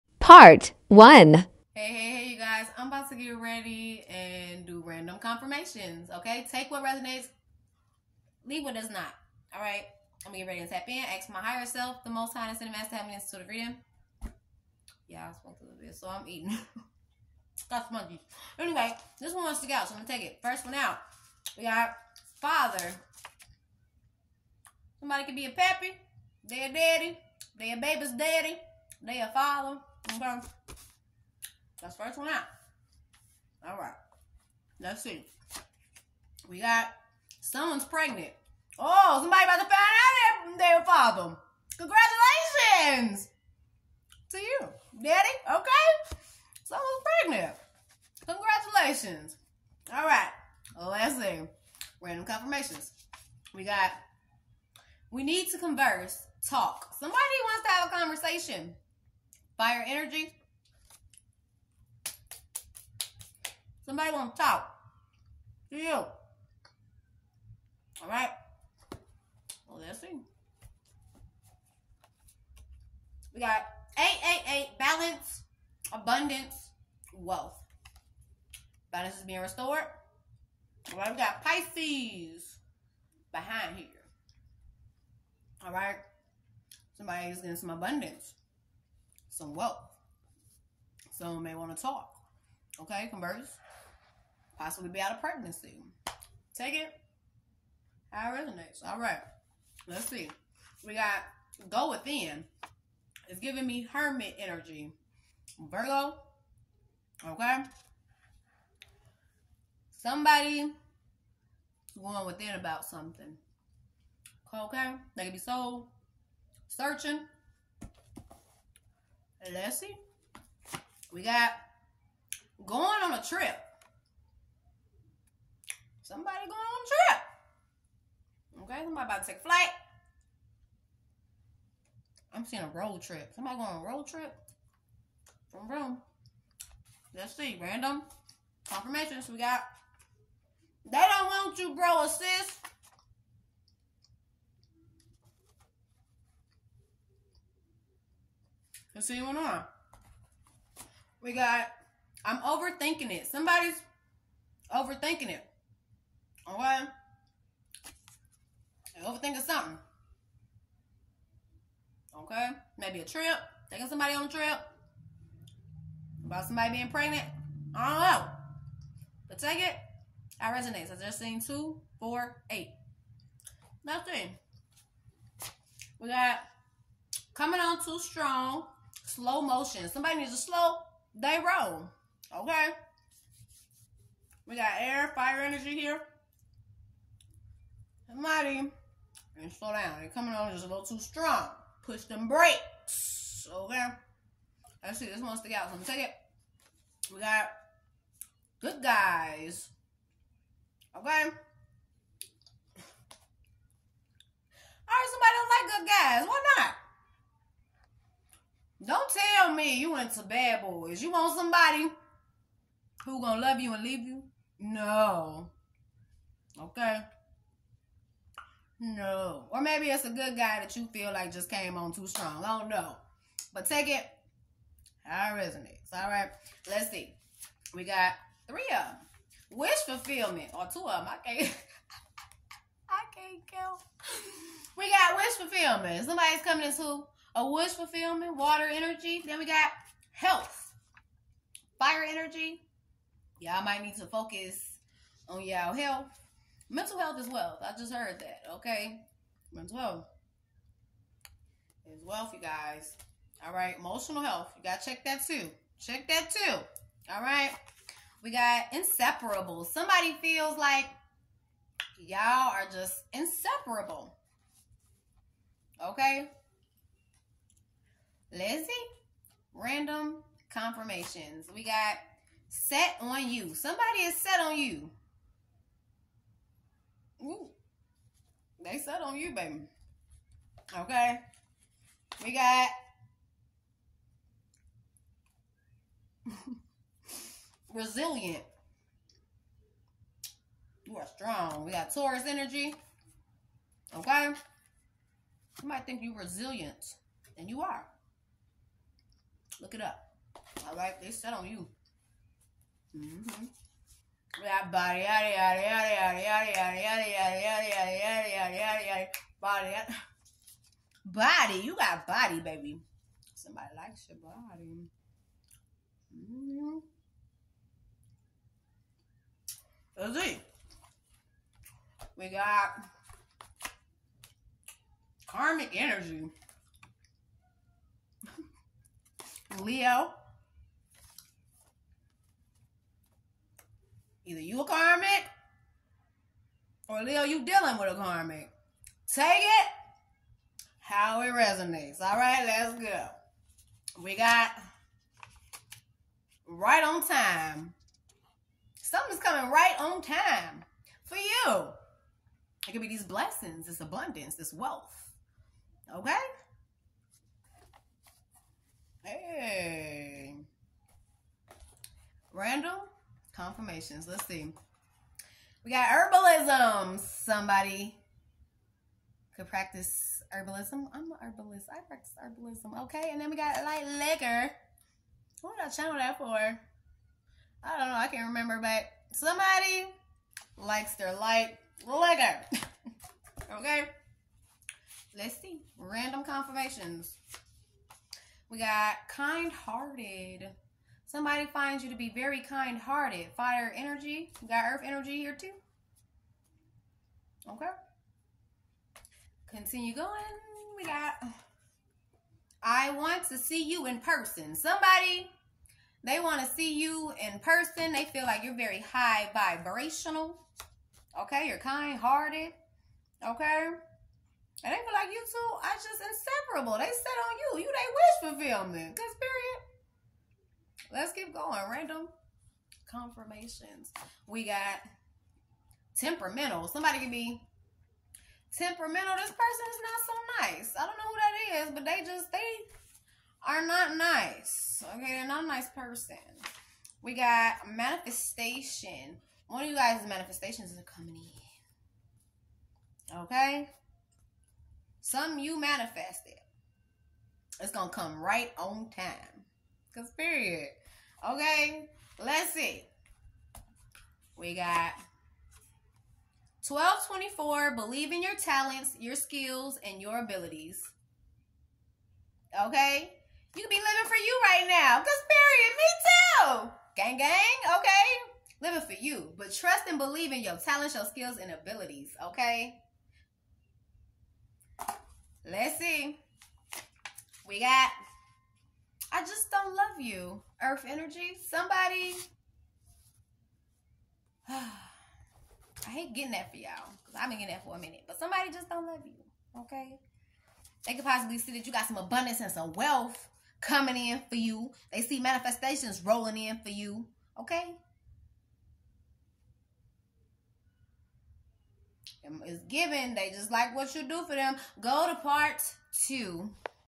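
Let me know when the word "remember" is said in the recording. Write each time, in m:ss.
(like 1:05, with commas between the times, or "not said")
6:18.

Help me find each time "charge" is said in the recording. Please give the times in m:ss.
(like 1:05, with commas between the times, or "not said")
not said.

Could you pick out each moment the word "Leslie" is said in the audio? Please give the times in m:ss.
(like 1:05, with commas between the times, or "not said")
1:59, 4:28.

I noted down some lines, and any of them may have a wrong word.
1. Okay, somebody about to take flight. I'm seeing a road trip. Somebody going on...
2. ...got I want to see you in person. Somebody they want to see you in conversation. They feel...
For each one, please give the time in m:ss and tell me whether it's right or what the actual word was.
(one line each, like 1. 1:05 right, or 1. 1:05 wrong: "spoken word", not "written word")
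1. 2:08 right
2. 6:40 wrong: "person", not "conversation".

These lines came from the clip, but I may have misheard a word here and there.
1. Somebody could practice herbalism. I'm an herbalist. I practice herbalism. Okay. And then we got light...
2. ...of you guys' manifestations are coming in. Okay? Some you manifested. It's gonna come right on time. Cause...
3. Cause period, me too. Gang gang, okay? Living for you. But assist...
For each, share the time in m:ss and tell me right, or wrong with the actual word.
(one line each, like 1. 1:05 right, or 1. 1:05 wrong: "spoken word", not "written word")
1. 6:06 right
2. 7:19 right
3. 7:44 wrong: "trust", not "assist".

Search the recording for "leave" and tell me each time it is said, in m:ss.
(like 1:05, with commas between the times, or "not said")
0:08, 3:33.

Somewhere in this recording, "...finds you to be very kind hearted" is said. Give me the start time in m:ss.
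6:31.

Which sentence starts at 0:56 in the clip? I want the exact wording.
Somebody wants to have a conversation.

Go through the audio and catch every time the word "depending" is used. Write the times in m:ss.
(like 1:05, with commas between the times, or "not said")
not said.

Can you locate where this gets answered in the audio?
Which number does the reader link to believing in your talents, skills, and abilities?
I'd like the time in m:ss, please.
7:36.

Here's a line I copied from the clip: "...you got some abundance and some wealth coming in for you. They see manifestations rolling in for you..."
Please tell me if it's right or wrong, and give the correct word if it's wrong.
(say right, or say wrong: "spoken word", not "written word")
right.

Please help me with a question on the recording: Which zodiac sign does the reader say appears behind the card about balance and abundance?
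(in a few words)
Pisces.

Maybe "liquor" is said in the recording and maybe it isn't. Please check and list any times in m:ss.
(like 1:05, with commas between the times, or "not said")
6:13, 6:21.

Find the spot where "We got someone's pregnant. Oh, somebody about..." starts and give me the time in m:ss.
0:36.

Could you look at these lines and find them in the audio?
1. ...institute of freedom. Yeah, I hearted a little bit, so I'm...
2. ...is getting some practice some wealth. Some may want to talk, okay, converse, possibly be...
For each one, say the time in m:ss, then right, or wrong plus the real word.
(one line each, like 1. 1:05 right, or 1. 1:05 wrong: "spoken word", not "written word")
1. 0:13 wrong: "smoked", not "hearted"
2. 1:27 wrong: "abundance", not "practice".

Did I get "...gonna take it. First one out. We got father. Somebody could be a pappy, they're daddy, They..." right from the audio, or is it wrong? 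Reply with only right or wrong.
right.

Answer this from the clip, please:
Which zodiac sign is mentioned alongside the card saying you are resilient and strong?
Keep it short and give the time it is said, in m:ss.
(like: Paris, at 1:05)
Taurus, at 4:51.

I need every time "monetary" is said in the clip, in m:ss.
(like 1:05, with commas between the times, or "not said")
not said.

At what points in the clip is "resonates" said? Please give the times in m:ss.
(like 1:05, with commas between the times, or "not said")
0:06, 1:38, 2:50, 3:45, 5:41.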